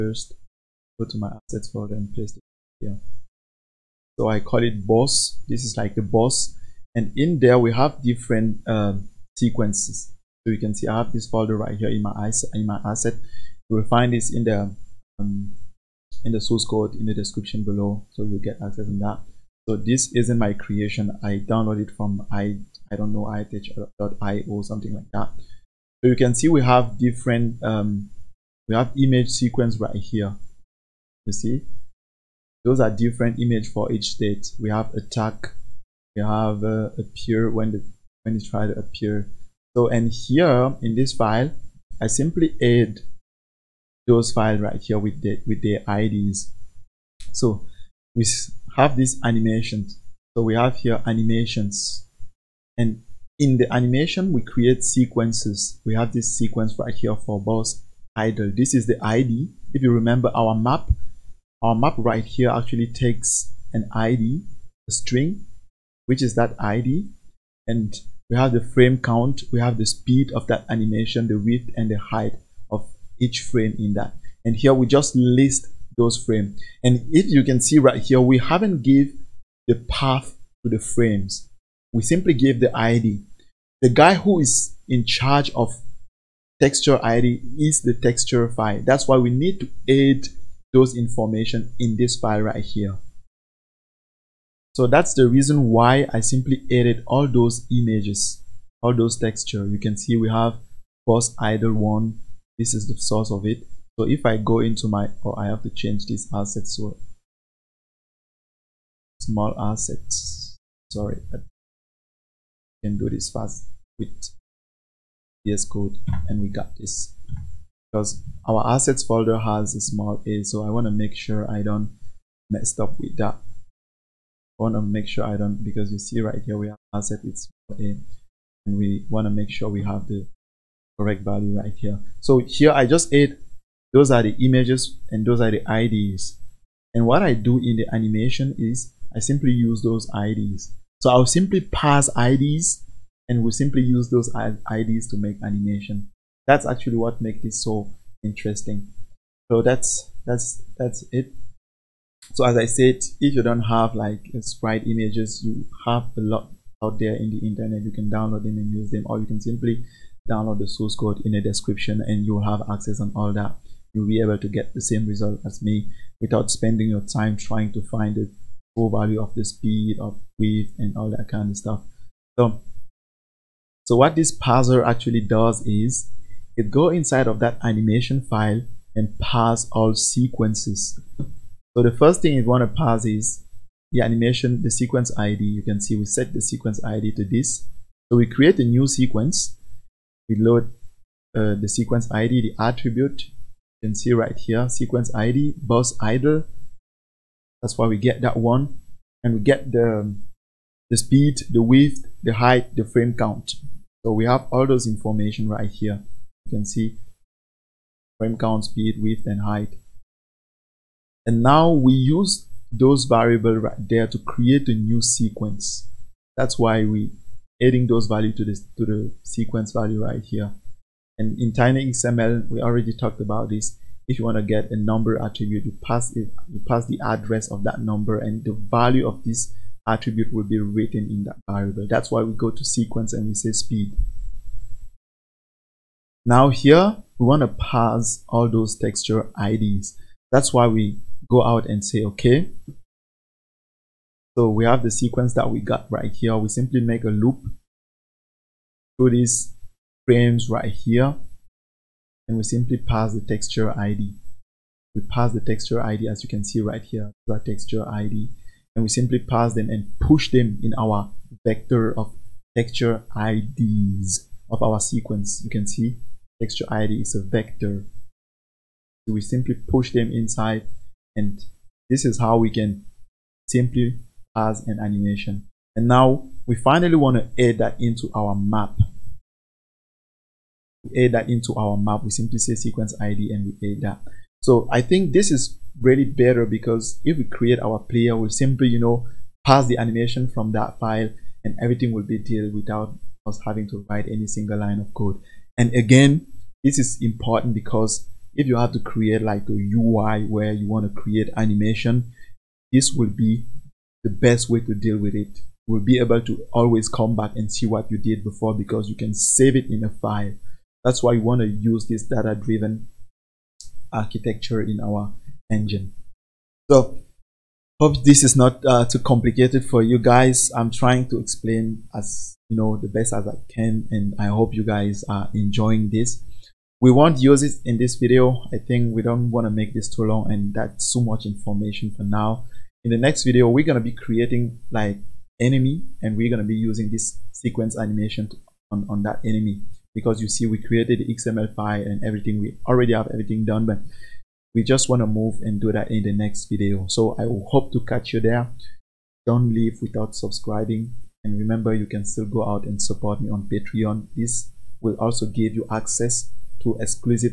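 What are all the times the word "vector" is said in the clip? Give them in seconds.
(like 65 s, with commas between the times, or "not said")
261 s, 267 s.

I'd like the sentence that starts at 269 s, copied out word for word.
So we simply push them inside and this is how we can simply pass an animation.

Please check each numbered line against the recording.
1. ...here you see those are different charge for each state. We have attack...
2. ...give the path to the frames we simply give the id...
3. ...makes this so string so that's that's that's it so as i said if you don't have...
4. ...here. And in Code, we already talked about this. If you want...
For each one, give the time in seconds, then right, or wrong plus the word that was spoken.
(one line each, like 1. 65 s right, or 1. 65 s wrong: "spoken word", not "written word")
1. 29 s wrong: "image", not "charge"
2. 78 s right
3. 147 s wrong: "interesting", not "string"
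4. 220 s wrong: "TinyXML", not "Code".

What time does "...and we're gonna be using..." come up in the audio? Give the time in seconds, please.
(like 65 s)
336 s.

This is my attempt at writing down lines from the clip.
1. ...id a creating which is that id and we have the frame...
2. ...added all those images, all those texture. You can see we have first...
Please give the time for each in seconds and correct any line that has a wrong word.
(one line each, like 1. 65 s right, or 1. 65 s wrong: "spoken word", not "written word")
1. 63 s wrong: "string", not "creating"
2. 96 s right.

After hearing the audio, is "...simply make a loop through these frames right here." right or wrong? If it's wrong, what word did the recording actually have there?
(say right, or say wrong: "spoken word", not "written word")
right.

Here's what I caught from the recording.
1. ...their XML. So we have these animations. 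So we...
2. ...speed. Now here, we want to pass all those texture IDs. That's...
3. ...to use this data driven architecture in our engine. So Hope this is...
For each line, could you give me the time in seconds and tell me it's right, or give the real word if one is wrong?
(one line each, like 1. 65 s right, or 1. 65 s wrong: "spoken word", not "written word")
1. 45 s wrong: "IDs", not "XML"
2. 233 s right
3. 311 s right.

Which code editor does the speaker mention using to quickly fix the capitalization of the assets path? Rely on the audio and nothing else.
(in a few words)
VS Code.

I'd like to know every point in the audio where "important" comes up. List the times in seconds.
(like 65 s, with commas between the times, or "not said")
297 s.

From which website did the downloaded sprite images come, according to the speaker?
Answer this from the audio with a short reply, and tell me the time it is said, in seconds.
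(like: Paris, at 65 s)
itch.io, at 23 s.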